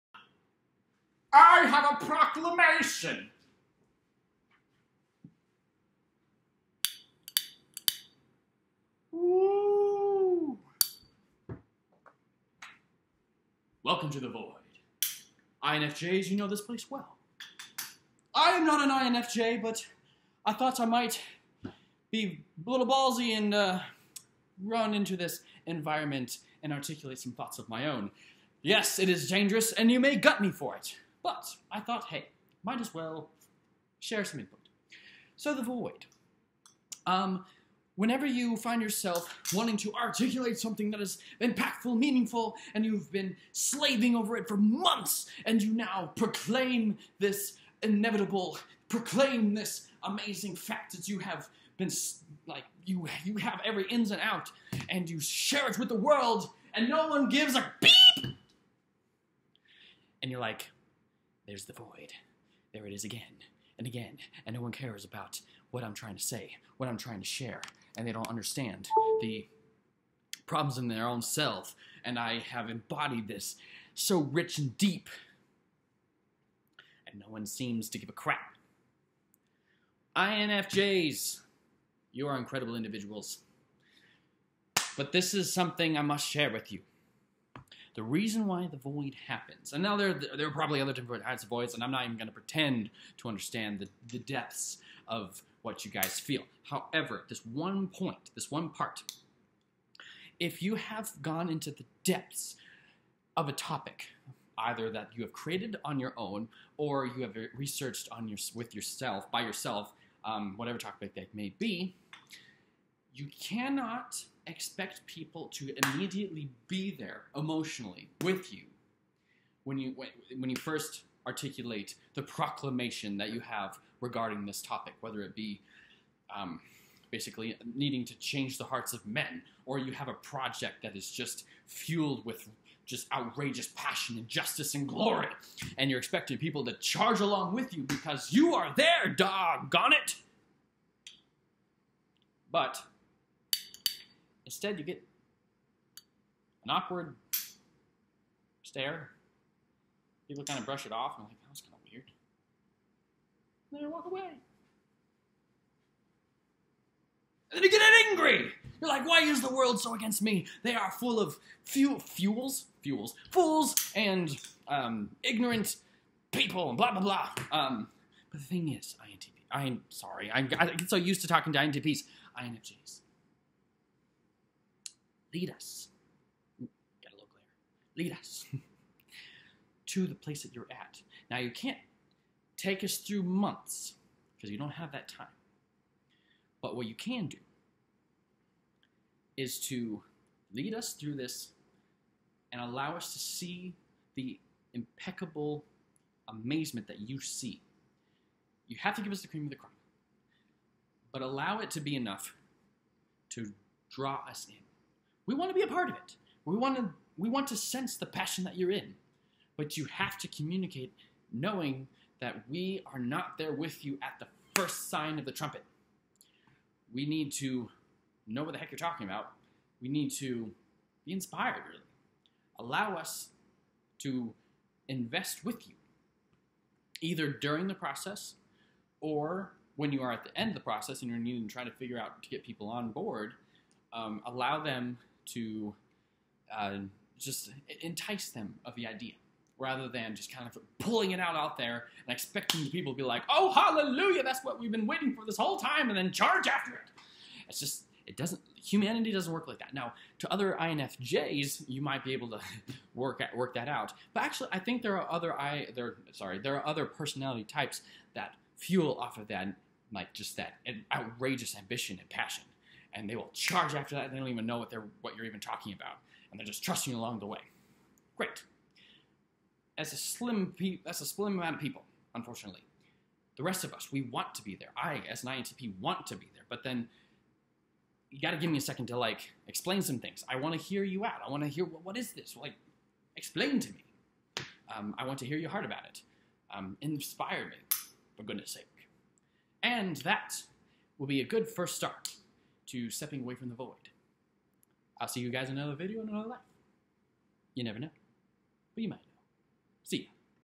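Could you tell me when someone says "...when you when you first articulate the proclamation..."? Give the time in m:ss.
1:59.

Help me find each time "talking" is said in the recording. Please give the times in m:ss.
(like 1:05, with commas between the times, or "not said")
2:51, 3:38, 4:25.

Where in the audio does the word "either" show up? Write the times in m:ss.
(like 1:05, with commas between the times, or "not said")
1:44, 3:47.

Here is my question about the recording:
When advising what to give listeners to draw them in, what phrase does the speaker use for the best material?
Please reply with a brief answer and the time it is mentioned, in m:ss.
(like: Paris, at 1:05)
the cream of the crop, at 3:19.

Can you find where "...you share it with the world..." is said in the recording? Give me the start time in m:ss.
0:55.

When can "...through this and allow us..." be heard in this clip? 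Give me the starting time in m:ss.
3:10.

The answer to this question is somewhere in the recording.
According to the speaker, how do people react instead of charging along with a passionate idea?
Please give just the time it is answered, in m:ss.
2:24.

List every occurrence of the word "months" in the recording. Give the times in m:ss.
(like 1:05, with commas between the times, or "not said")
0:44, 3:03.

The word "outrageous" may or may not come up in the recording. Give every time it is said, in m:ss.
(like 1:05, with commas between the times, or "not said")
2:13, 4:20.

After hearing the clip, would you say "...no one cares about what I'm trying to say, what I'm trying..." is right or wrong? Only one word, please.
right.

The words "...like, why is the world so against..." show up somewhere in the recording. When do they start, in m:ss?
2:38.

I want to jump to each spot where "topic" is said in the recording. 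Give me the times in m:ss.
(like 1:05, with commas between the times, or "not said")
1:43, 1:50, 2:04.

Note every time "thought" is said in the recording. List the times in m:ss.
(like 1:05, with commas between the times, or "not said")
0:20, 0:27, 0:31.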